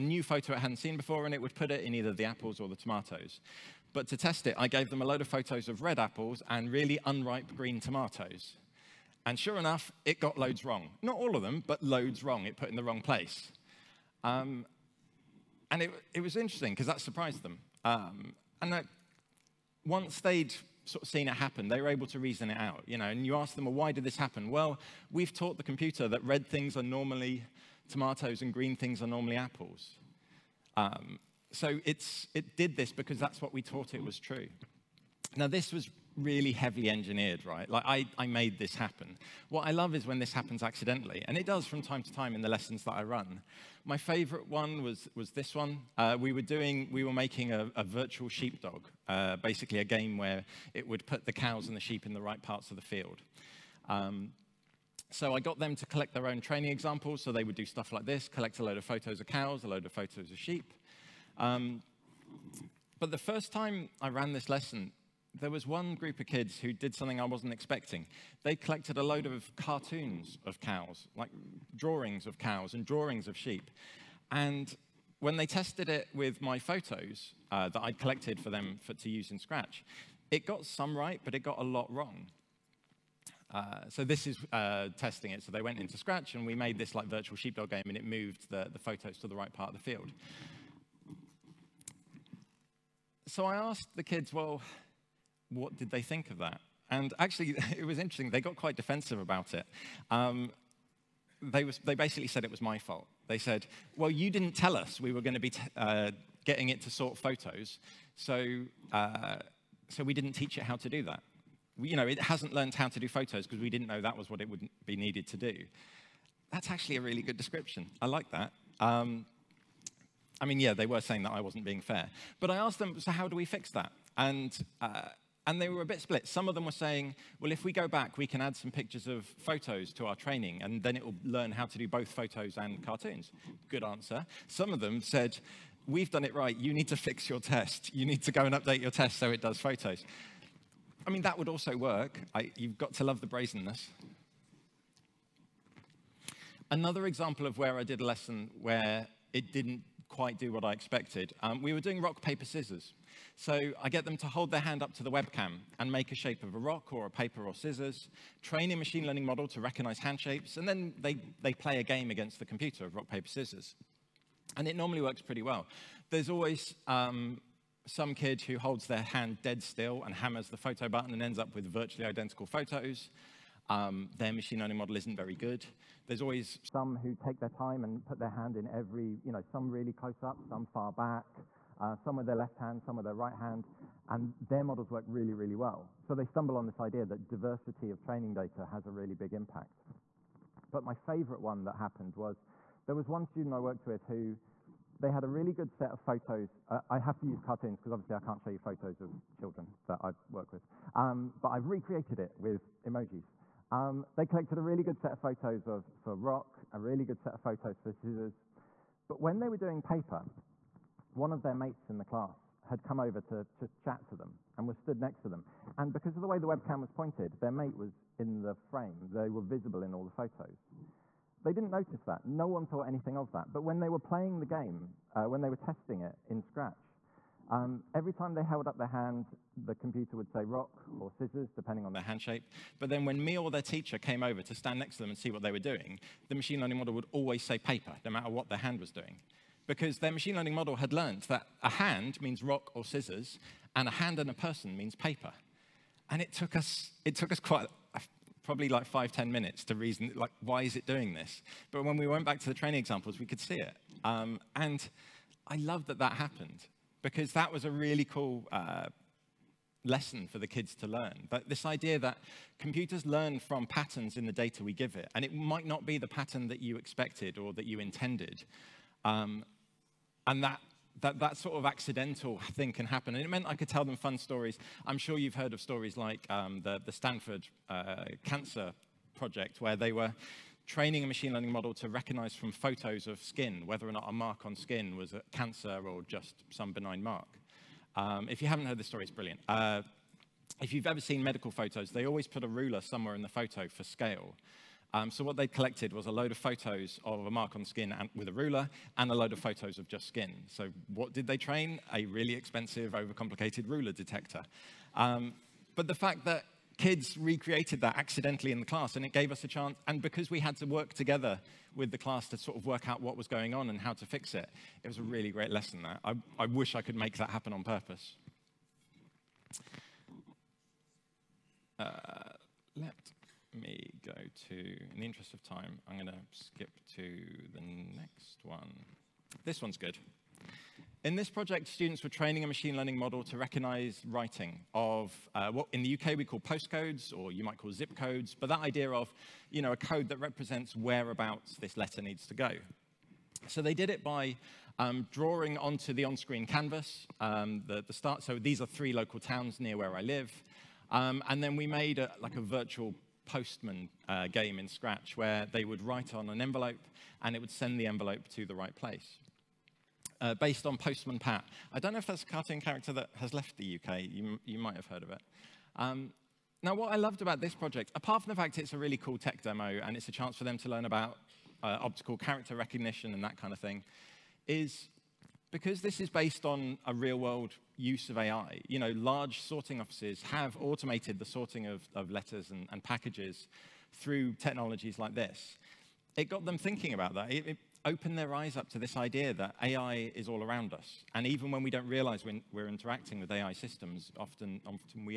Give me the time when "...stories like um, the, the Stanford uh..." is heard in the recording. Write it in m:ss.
4:35.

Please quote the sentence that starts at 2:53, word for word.
Um, their machine learning model isn't very good.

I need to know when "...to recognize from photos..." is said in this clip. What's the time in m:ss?
4:41.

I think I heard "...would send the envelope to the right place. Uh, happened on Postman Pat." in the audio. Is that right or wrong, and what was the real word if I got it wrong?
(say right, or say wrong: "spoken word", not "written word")
wrong: "based", not "happened".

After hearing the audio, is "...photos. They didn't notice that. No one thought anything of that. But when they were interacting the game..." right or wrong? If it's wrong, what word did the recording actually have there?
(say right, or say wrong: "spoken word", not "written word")
wrong: "playing", not "interacting".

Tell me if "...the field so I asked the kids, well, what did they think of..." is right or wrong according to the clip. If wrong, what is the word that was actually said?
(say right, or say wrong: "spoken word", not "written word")
right.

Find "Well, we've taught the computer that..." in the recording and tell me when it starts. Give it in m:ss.
0:24.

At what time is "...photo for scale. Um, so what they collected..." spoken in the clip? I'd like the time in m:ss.
4:53.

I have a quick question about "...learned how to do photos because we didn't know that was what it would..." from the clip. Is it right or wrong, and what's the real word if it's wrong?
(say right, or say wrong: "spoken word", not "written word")
right.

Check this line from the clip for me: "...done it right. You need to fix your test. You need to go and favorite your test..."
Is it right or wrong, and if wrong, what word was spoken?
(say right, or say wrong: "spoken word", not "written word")
wrong: "update", not "favorite".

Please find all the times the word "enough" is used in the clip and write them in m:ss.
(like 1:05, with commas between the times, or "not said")
0:09.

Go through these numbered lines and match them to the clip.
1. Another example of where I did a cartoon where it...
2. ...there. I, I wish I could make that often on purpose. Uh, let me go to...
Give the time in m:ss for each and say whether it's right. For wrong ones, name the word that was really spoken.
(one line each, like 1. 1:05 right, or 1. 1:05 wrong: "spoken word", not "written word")
1. 2:26 wrong: "lesson", not "cartoon"
2. 5:15 wrong: "happen", not "often".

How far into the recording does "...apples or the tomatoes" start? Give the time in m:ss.
0:02.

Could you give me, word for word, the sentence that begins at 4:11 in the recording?
But when we went back to the training examples, we could see it.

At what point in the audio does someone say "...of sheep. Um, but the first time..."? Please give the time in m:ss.
1:00.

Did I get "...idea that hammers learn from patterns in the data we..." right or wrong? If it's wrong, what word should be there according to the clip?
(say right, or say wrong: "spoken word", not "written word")
wrong: "computers", not "hammers".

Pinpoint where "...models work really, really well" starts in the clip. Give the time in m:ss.
3:04.